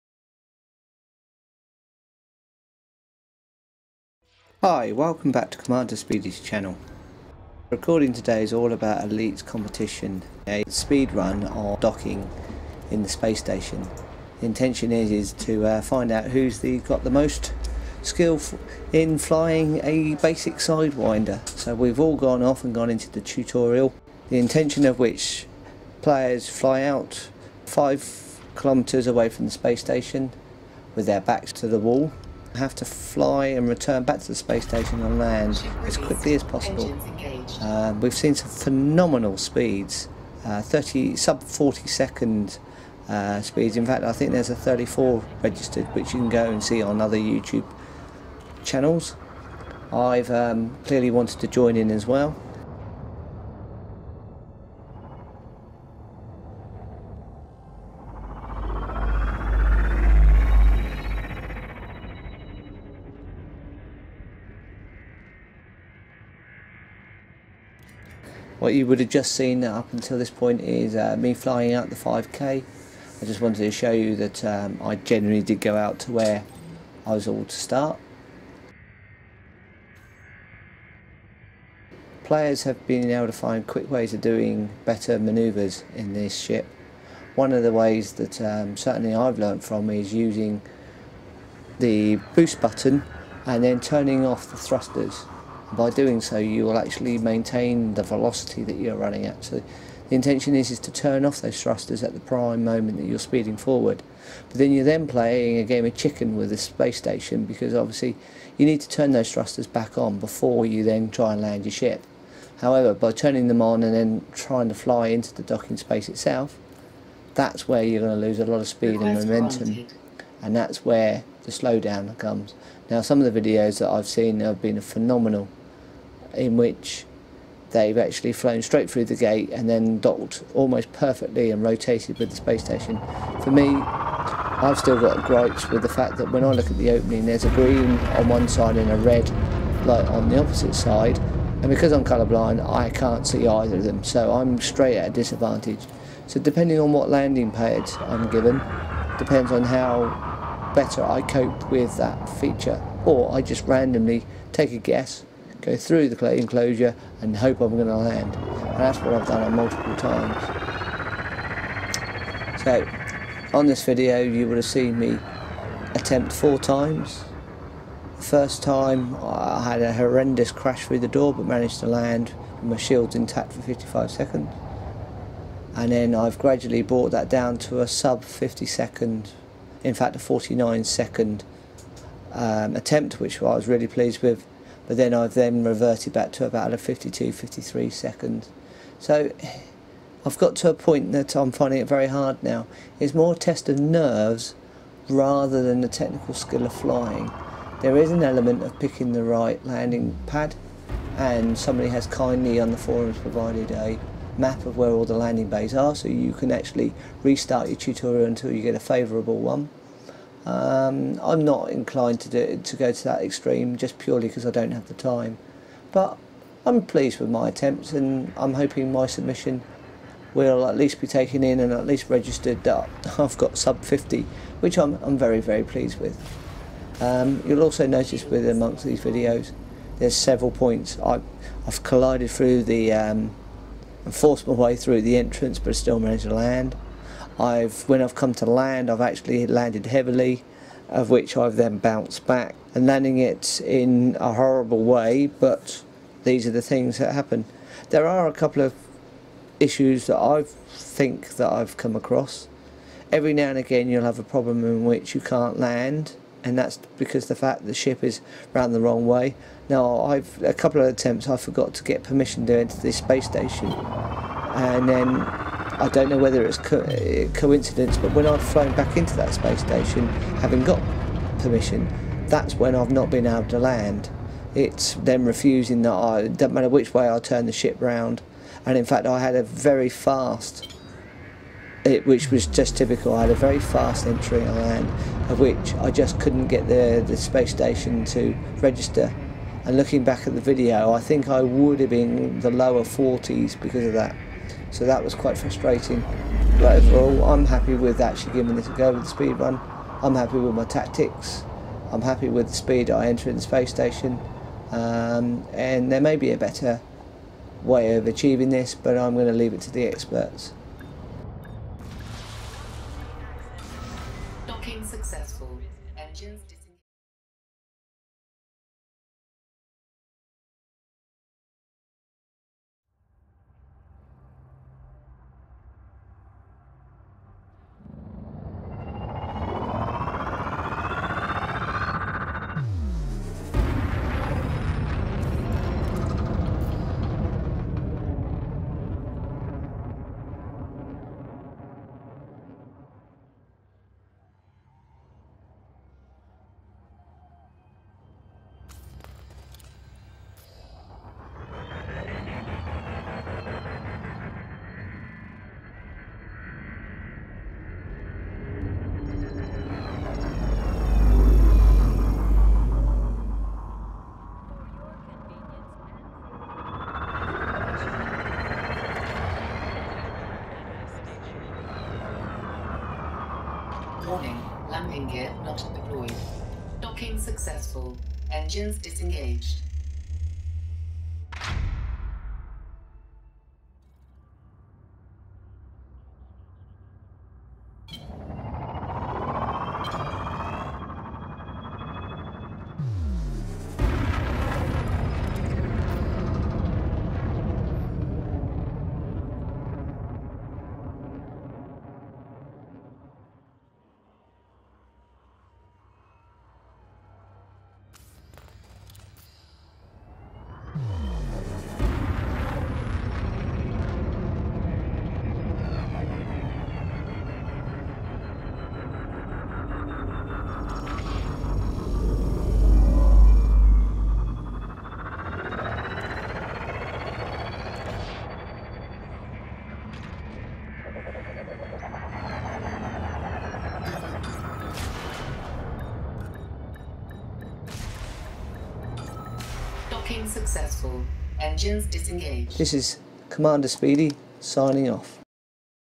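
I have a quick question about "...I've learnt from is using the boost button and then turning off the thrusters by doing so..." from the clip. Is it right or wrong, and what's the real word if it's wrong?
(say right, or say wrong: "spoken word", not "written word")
right.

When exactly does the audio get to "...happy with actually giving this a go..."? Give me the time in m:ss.
4:57.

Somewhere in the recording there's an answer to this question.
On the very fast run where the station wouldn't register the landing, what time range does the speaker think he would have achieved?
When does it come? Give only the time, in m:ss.
4:52.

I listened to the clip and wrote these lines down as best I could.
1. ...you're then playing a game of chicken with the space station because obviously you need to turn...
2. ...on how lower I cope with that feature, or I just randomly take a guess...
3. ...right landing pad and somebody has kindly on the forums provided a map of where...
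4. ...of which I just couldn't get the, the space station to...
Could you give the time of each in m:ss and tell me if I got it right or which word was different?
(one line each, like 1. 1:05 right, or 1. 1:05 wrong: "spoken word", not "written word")
1. 1:44 right
2. 2:29 wrong: "better", not "lower"
3. 3:19 right
4. 4:45 right.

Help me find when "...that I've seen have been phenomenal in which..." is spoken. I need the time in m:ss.
2:03.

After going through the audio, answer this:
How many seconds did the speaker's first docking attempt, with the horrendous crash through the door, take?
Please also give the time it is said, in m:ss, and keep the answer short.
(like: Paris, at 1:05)
55 seconds, at 2:53.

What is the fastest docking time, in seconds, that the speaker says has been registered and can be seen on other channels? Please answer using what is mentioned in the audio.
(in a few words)
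34.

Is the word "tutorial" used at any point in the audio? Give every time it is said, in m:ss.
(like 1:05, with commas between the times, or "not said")
0:23, 3:27.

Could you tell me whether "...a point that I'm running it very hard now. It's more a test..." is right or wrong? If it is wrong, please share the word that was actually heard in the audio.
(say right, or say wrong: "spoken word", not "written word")
wrong: "finding", not "running".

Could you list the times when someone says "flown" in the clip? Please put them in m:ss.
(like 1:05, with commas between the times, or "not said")
2:08, 4:28.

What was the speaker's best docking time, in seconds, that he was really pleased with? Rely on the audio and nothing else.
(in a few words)
49.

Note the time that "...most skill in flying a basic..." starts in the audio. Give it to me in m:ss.
0:17.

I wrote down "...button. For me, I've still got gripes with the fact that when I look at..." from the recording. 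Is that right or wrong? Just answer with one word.
wrong.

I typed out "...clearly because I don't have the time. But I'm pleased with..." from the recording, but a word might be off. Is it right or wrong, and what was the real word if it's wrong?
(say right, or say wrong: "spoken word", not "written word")
wrong: "purely", not "clearly".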